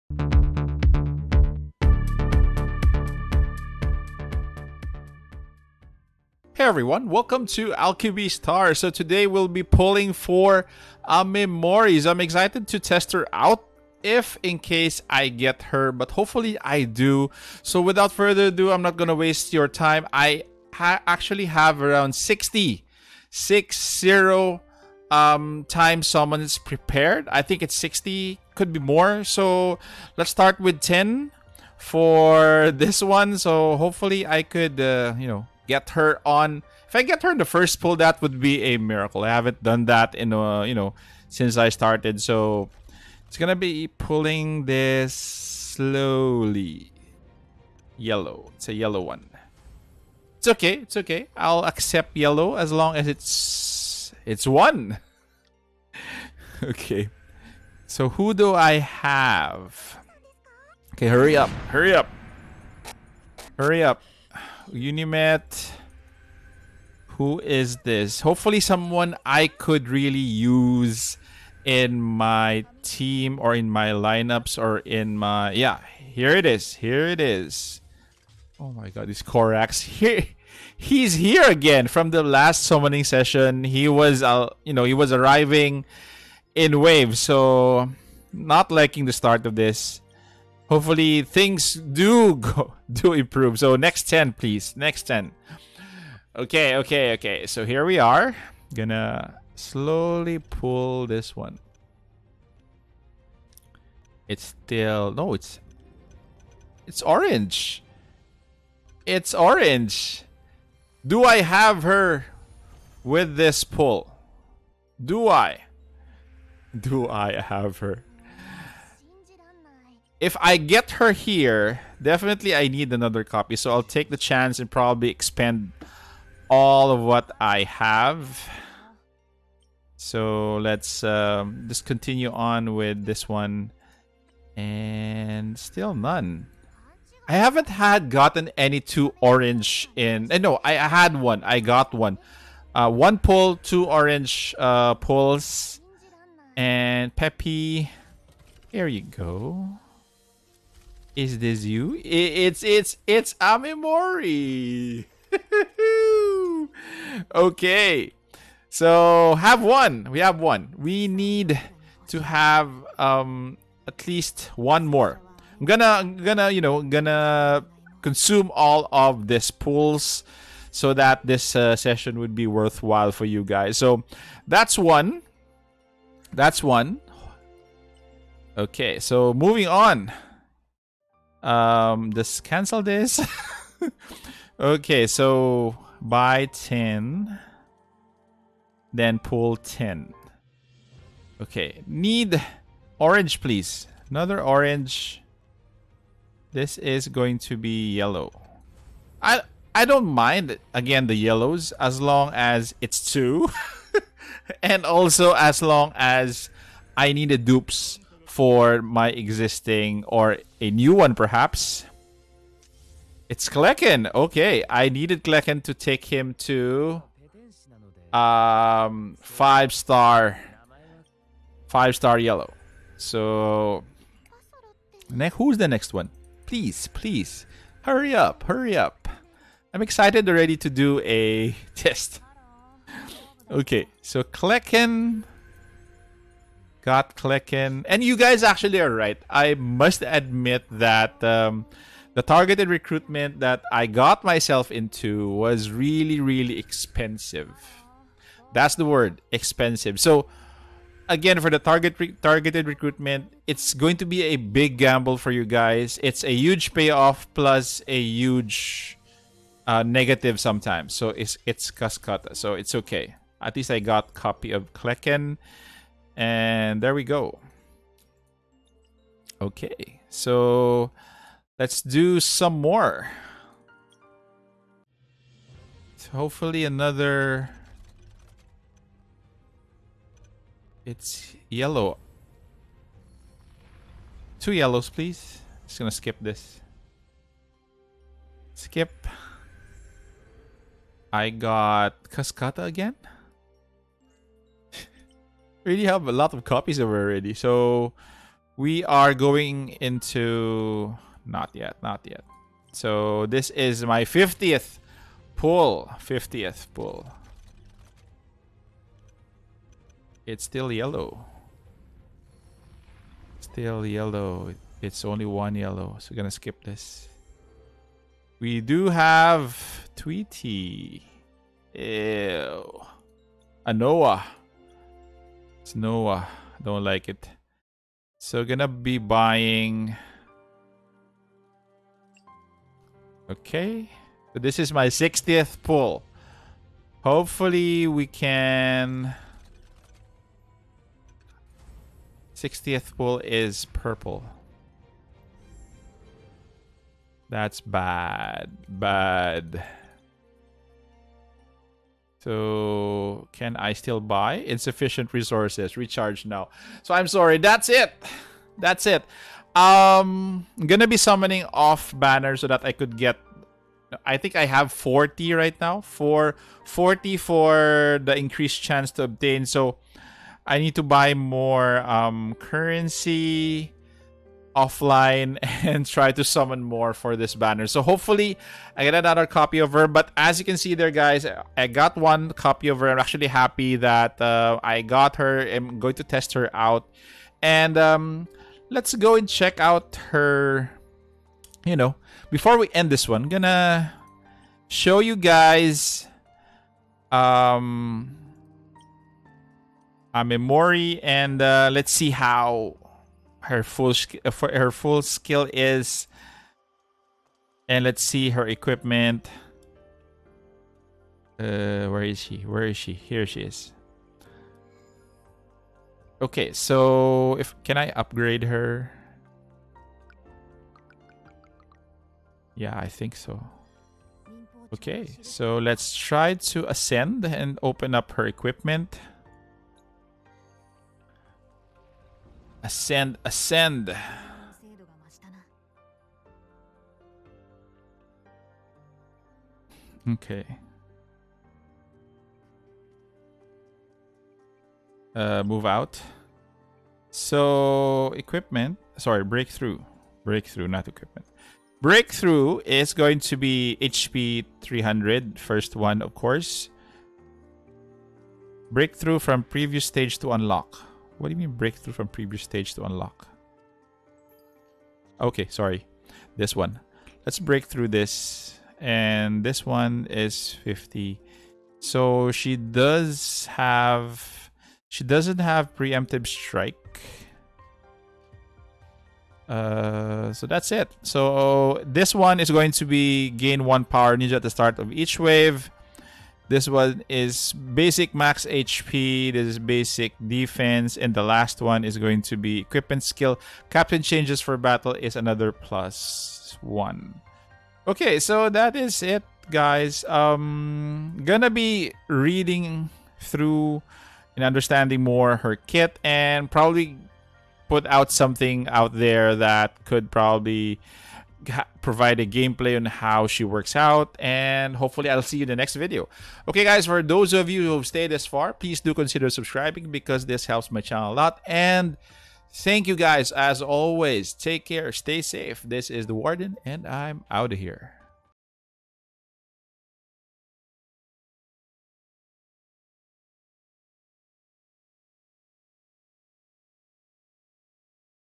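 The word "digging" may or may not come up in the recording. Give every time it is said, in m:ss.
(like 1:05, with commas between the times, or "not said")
not said.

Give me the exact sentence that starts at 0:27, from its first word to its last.
I think it's 60, could be more.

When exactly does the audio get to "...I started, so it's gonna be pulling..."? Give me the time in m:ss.
0:41.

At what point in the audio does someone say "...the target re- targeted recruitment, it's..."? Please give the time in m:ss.
4:11.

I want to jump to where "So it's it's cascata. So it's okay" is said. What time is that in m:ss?
4:20.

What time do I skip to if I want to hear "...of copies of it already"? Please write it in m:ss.
4:56.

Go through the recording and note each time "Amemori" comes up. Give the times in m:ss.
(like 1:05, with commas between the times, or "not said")
0:11, 2:33, 6:40.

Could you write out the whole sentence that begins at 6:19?
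But as you can see there, guys, I got one copy of her.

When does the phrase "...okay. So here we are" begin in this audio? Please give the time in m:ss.
1:37.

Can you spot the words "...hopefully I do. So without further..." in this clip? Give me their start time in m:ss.
0:16.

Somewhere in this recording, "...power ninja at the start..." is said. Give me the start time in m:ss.
8:03.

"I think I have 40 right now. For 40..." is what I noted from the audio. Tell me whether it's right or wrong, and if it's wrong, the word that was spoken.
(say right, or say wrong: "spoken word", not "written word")
right.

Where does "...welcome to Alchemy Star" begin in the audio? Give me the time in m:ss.
0:07.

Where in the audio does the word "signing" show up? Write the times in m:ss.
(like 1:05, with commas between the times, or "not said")
not said.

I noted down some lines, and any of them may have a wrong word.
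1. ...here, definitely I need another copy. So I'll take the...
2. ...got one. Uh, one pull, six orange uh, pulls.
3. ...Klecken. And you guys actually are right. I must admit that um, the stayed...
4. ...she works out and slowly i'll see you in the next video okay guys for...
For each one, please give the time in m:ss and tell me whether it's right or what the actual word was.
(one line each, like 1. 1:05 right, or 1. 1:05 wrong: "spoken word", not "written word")
1. 2:01 right
2. 2:21 wrong: "two", not "six"
3. 3:57 wrong: "targeted", not "stayed"
4. 8:33 wrong: "hopefully", not "slowly".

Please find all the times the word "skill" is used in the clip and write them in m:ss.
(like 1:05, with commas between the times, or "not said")
6:45, 8:13.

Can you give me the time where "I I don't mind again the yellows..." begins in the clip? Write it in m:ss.
3:19.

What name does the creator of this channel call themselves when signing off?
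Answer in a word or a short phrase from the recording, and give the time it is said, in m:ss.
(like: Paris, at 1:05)
The Warden, at 8:46.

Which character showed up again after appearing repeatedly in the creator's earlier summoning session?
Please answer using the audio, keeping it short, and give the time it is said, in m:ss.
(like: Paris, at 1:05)
Korax, at 1:19.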